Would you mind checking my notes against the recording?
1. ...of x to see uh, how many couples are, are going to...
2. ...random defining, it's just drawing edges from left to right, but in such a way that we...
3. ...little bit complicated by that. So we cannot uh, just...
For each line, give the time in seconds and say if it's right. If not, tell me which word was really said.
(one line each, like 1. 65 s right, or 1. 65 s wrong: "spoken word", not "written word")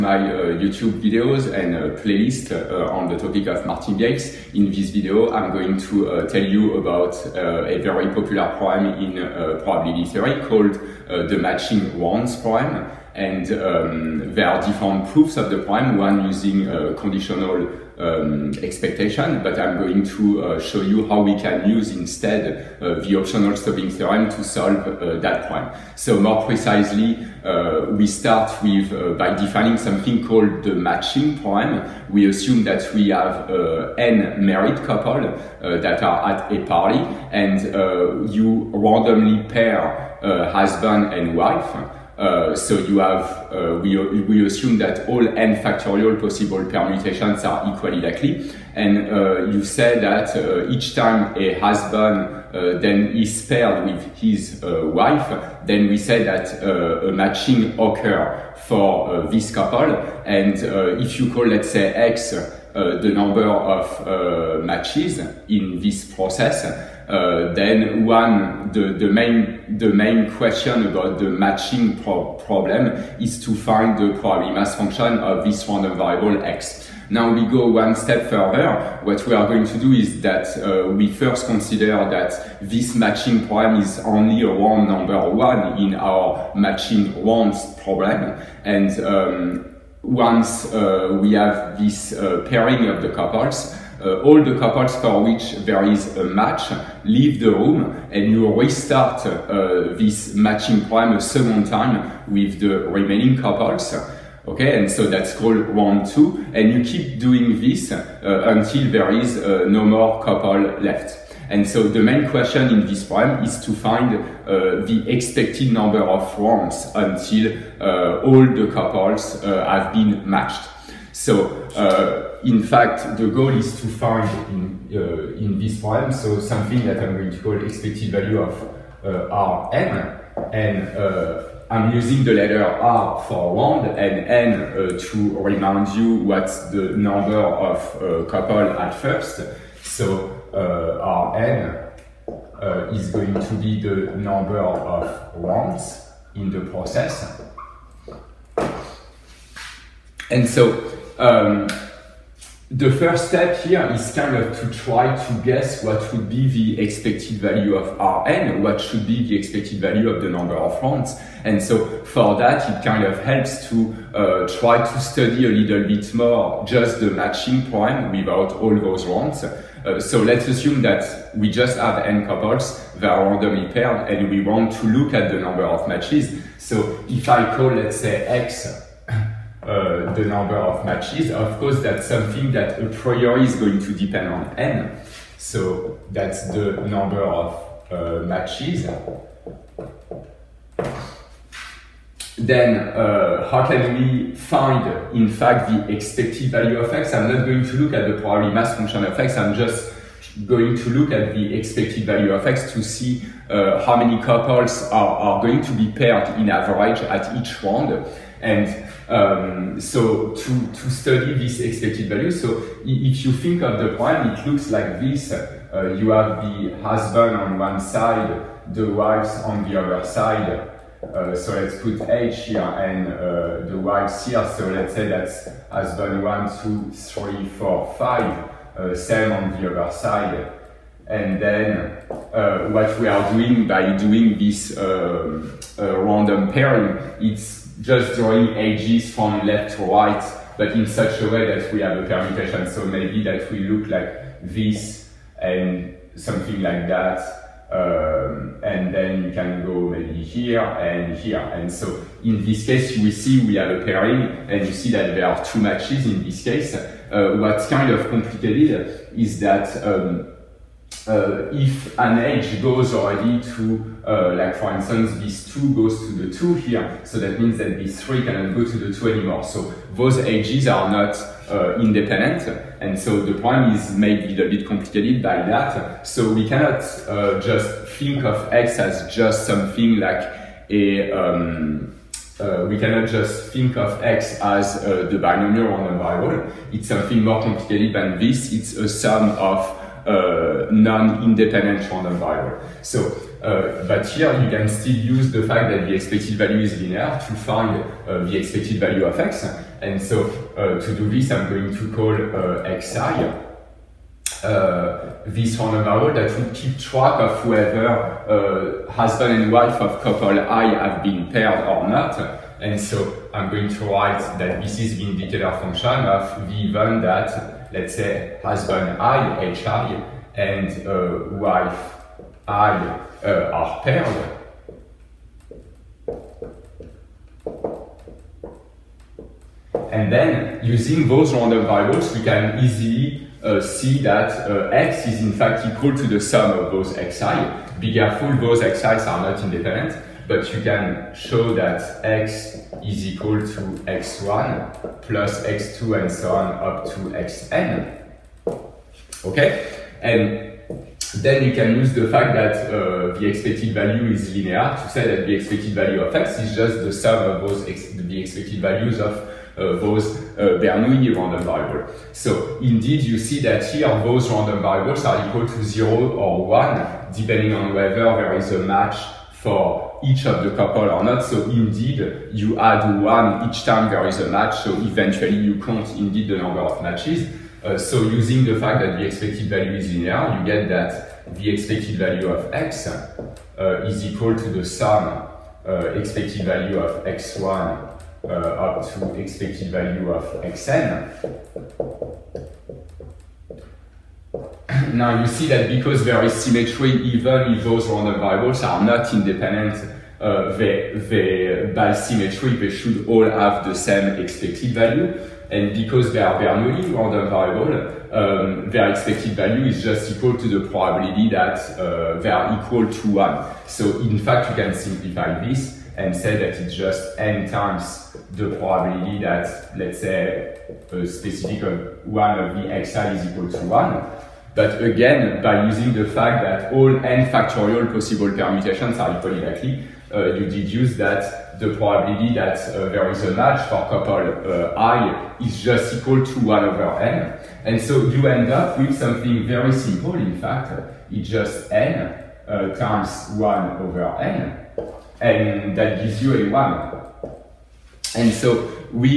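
1. 202 s right
2. 235 s wrong: "pairing", not "defining"
3. 274 s right.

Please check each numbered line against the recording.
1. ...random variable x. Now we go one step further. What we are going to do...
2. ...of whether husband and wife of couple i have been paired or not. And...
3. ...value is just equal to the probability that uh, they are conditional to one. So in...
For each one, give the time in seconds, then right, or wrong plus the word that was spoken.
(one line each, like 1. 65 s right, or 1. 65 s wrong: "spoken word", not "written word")
1. 75 s right
2. 307 s right
3. 409 s wrong: "equal", not "conditional".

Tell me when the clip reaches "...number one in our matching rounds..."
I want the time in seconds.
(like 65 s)
84 s.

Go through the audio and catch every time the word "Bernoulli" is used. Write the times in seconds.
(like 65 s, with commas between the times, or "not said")
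360 s, 406 s.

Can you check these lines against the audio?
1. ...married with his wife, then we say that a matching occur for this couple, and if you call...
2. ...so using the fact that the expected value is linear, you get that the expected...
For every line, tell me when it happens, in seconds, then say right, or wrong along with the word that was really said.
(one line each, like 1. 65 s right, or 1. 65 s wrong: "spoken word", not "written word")
1. 53 s wrong: "paired", not "married"
2. 377 s right.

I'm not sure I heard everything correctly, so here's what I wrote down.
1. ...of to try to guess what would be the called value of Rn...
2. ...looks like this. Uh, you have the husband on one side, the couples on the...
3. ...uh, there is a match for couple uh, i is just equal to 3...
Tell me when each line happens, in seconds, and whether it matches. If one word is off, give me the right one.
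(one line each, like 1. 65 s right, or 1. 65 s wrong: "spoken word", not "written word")
1. 154 s wrong: "expected", not "called"
2. 214 s wrong: "wives", not "couples"
3. 432 s wrong: "1", not "3".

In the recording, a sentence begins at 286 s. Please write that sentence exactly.
It's something more complicated than this.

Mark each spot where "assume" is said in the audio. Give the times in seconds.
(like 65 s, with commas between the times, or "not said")
32 s, 44 s, 170 s.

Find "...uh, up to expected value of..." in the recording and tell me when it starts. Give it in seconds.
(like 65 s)
388 s.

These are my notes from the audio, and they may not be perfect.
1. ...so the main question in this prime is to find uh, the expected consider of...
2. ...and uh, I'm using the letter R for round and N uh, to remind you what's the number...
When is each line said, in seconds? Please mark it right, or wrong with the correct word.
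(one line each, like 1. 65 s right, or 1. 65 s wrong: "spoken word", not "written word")
1. 111 s wrong: "number", not "consider"
2. 130 s right.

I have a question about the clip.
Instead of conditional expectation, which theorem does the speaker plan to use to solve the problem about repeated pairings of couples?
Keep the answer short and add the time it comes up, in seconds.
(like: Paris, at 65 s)
Optional stopping theorem, at 23 s.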